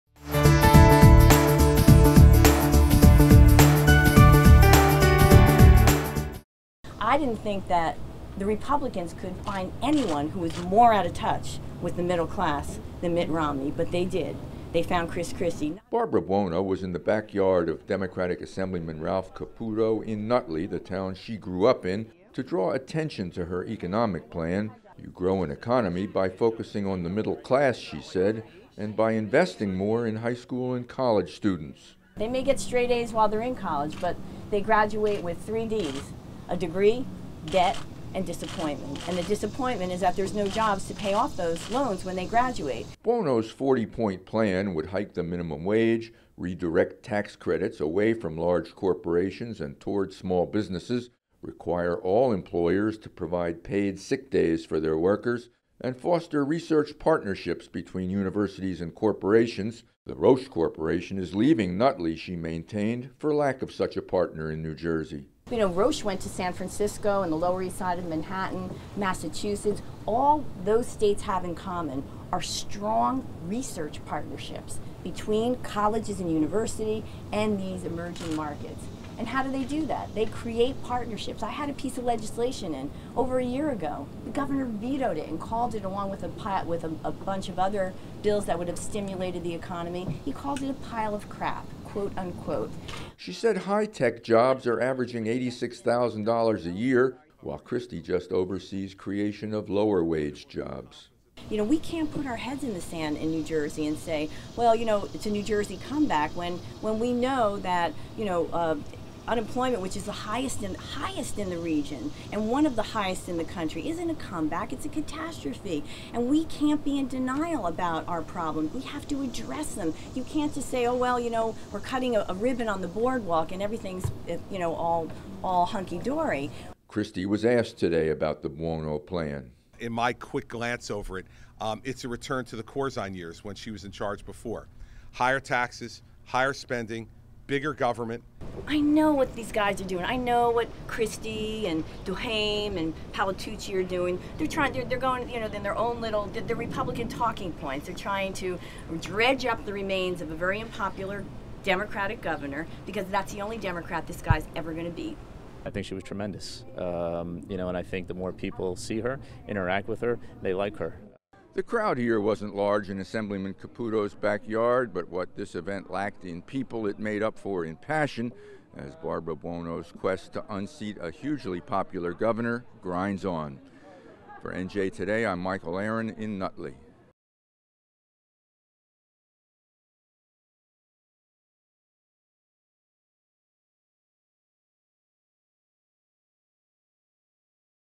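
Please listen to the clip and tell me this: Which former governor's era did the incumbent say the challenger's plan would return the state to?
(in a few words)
Corzine.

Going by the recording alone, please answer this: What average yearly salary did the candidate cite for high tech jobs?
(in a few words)
$86,000.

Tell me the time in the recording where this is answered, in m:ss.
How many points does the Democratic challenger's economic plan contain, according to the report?
0:43.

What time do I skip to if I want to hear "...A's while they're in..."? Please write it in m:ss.
0:32.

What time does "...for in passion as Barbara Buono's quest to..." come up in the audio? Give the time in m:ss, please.
2:47.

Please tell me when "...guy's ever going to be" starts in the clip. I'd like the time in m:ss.
2:34.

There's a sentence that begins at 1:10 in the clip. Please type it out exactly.
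All those states have in common are strong research partnerships between colleges and university and these emerging markets.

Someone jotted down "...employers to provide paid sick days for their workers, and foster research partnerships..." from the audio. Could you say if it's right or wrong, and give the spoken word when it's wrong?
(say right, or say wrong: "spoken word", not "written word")
right.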